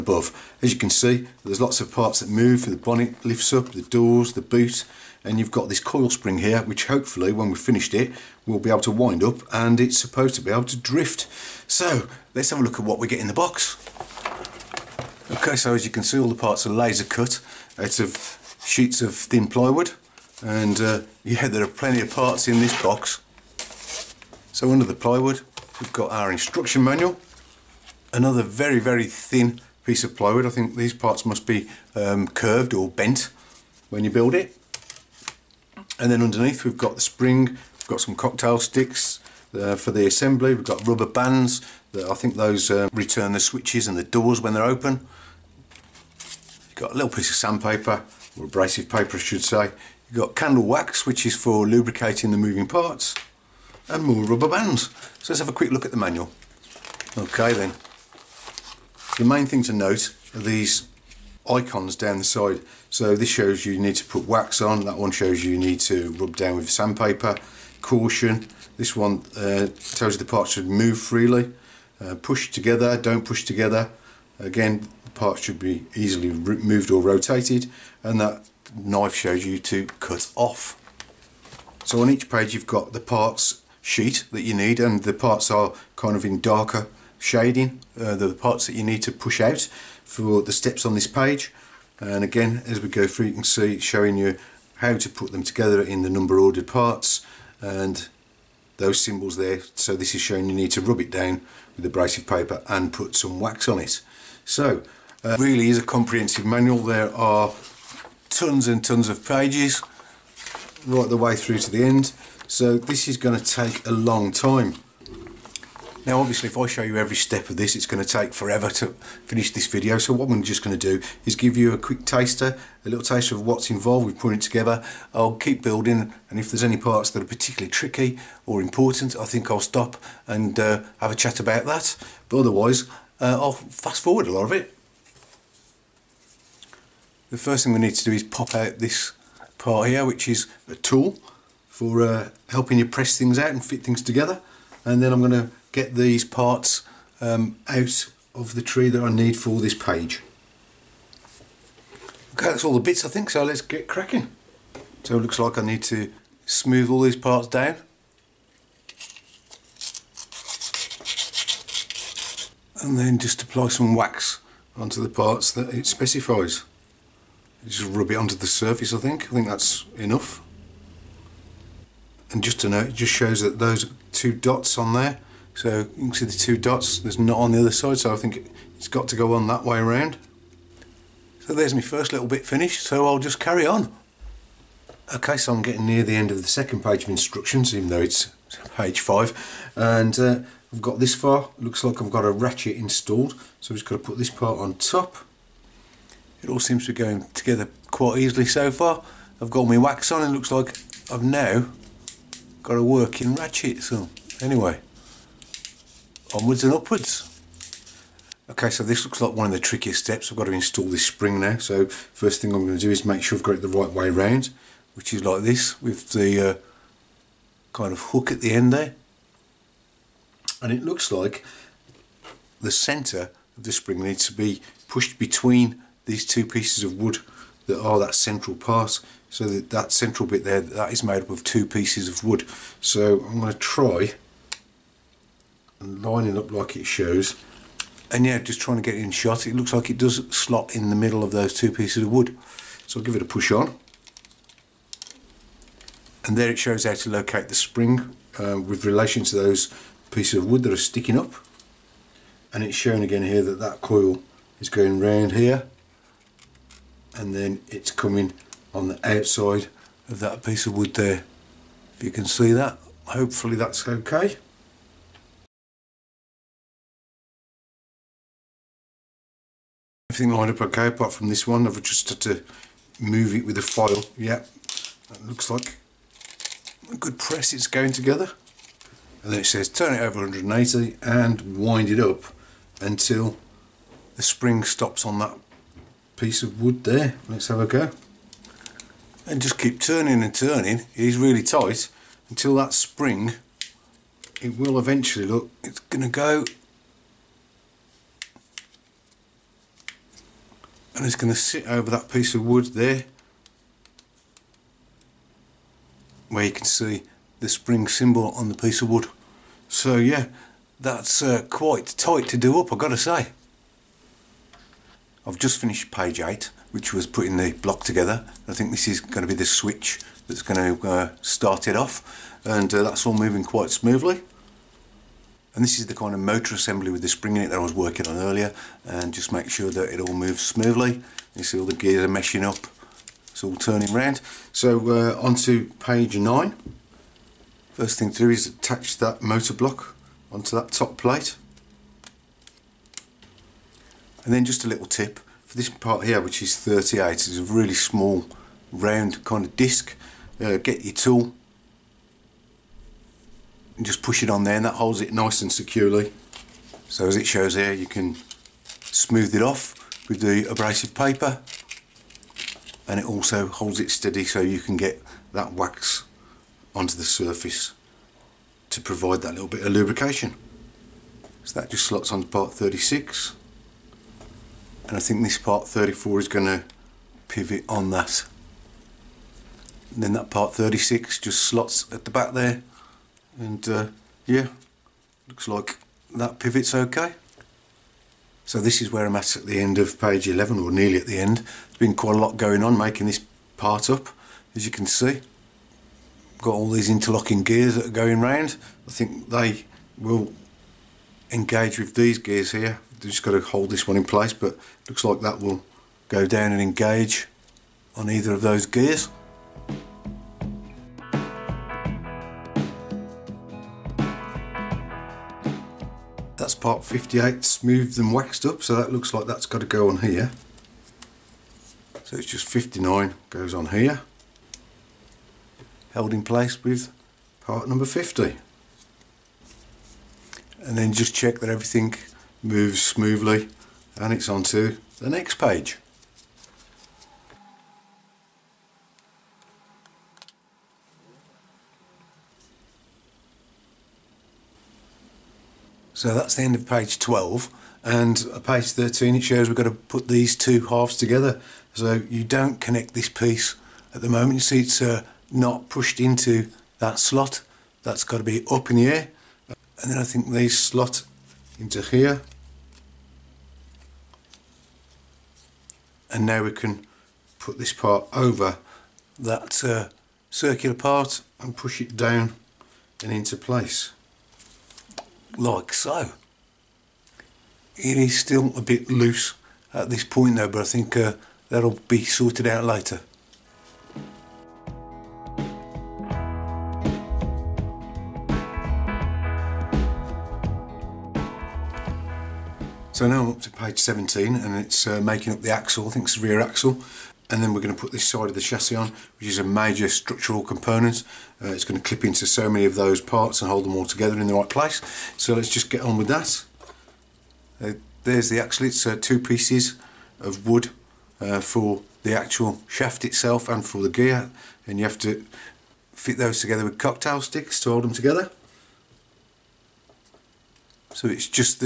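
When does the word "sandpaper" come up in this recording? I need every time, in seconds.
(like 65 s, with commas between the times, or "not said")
47 s, 66 s.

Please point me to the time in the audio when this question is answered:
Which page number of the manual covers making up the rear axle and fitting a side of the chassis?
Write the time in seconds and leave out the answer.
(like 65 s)
493 s.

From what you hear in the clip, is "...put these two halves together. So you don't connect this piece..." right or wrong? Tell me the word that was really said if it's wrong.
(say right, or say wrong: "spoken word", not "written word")
right.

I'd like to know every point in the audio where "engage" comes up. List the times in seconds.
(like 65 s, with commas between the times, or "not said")
401 s, 406 s.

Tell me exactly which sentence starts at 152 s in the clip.
Okay, that's all the bits I think, so let's get cracking.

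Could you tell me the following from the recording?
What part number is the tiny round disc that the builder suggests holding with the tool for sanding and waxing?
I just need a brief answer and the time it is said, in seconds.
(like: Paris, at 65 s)
38, at 346 s.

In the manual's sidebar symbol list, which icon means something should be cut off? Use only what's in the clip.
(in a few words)
Knife.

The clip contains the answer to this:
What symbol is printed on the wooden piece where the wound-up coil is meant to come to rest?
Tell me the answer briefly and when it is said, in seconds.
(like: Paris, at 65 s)
Spring symbol, at 307 s.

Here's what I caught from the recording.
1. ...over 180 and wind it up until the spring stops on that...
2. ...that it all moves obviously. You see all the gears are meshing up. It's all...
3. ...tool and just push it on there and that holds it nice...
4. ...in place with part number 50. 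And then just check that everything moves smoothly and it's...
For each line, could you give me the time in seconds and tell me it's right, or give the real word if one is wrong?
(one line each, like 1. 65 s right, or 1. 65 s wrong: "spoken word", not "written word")
1. 280 s right
2. 329 s wrong: "smoothly", not "obviously"
3. 350 s right
4. 426 s right.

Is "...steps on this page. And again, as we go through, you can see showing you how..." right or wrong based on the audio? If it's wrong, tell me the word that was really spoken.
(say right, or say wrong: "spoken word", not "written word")
right.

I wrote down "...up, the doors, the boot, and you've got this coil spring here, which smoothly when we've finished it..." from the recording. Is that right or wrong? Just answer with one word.
wrong.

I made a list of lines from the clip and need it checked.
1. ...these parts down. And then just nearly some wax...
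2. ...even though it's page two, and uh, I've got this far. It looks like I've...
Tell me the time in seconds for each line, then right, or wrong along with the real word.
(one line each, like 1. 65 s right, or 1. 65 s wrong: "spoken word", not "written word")
1. 157 s wrong: "apply", not "nearly"
2. 187 s wrong: "five", not "two".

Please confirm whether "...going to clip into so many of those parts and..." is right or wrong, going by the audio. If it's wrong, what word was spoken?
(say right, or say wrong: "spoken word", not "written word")
right.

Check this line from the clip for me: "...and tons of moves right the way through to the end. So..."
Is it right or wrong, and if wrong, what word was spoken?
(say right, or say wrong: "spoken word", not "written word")
wrong: "pages", not "moves".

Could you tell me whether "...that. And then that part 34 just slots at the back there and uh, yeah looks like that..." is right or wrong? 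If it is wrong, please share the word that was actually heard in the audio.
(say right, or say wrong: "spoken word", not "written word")
wrong: "36", not "34".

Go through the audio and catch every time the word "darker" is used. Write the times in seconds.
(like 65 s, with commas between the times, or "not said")
86 s.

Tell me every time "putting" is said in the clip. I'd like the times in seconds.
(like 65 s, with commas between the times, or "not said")
124 s, 317 s.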